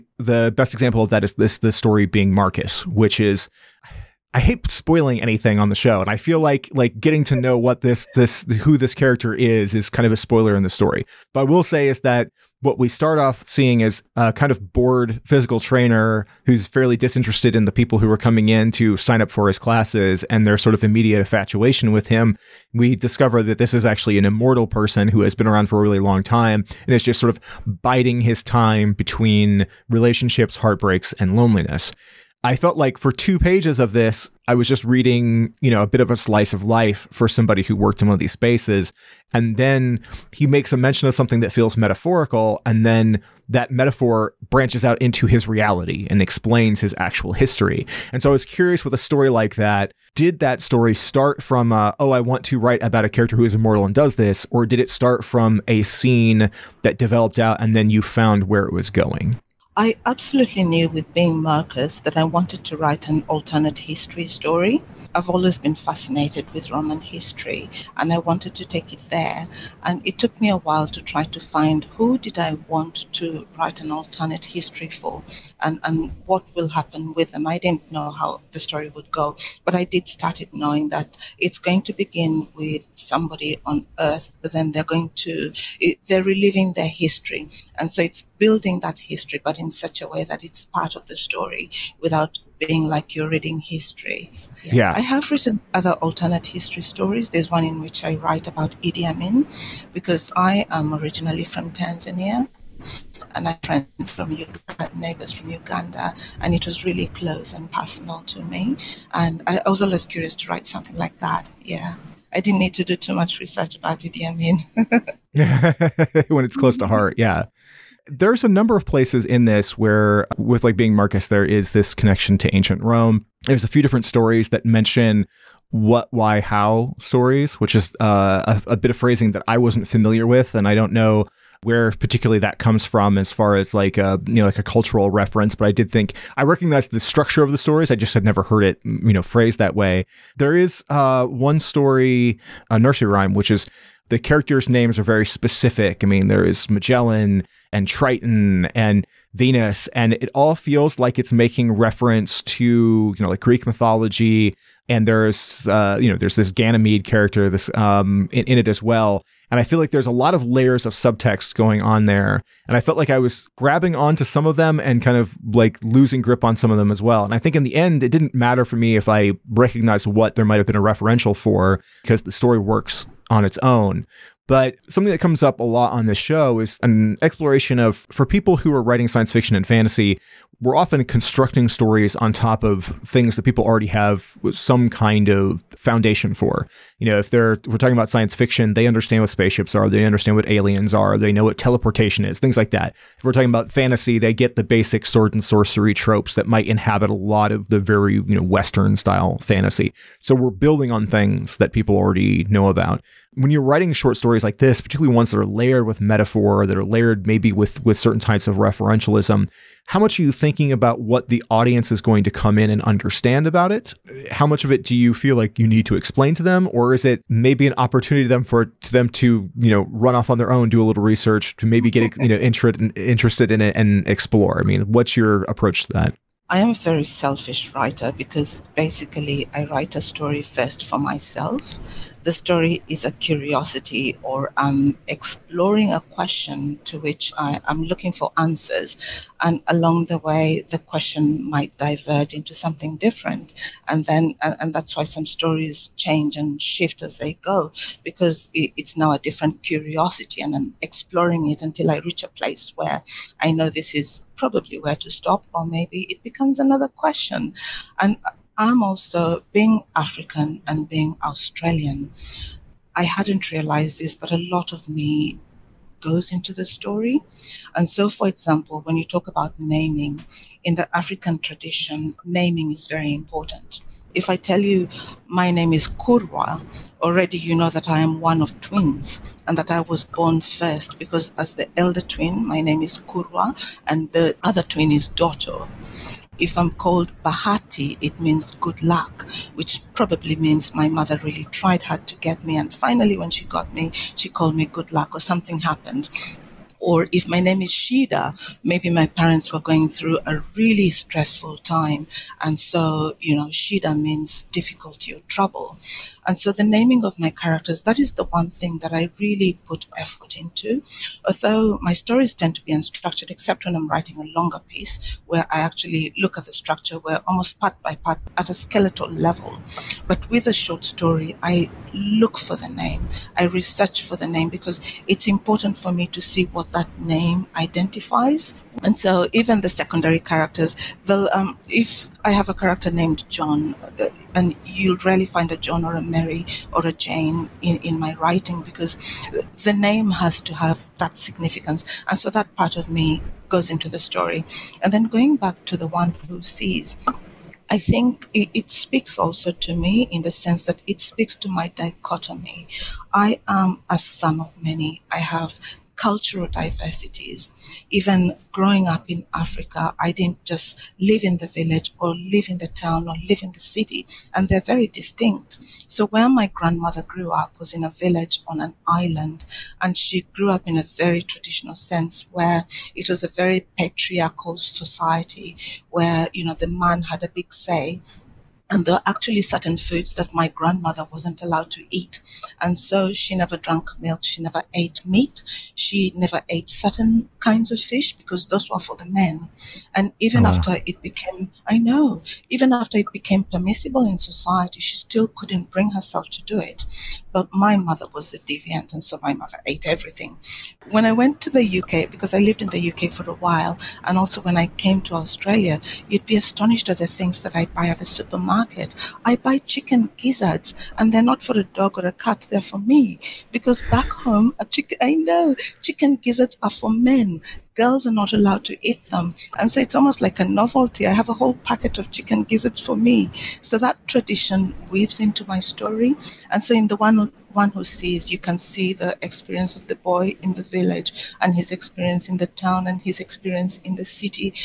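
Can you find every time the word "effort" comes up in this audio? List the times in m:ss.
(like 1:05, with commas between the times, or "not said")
5:09.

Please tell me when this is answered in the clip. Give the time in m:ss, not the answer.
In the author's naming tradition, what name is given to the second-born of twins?
4:45.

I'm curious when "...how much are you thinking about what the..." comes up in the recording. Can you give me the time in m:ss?
3:29.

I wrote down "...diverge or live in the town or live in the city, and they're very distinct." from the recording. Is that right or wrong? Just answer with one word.
wrong.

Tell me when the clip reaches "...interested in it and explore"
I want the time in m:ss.
3:42.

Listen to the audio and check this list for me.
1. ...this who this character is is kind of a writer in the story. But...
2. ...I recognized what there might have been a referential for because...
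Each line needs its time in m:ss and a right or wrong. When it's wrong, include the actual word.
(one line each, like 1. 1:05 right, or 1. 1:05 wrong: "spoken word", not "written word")
1. 0:08 wrong: "spoiler", not "writer"
2. 2:49 right.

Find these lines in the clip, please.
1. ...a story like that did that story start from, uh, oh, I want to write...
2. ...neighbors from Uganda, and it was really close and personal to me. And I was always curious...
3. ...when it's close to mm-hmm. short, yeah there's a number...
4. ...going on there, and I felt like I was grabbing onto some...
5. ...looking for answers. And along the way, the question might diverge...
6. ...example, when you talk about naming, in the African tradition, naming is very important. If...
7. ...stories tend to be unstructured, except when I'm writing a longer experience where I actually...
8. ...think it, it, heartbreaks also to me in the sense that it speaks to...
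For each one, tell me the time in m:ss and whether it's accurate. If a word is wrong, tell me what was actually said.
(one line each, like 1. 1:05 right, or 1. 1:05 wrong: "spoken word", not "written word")
1. 0:48 right
2. 1:44 right
3. 1:56 wrong: "heart", not "short"
4. 2:41 right
5. 3:57 right
6. 4:28 right
7. 5:11 wrong: "piece", not "experience"
8. 5:47 wrong: "speaks", not "heartbreaks".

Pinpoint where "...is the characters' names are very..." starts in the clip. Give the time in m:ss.
2:23.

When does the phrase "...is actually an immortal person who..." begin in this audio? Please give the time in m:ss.
0:23.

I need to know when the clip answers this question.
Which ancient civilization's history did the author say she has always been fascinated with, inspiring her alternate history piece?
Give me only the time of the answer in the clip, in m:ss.
1:06.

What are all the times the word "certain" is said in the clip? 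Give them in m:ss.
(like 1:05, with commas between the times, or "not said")
3:27, 6:19, 6:26.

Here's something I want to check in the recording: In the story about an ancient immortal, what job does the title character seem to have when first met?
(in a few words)
physical trainer.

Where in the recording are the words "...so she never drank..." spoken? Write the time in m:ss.
6:22.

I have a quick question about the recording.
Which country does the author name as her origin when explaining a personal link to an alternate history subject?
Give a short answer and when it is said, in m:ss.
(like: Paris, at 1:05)
Tanzania, at 1:41.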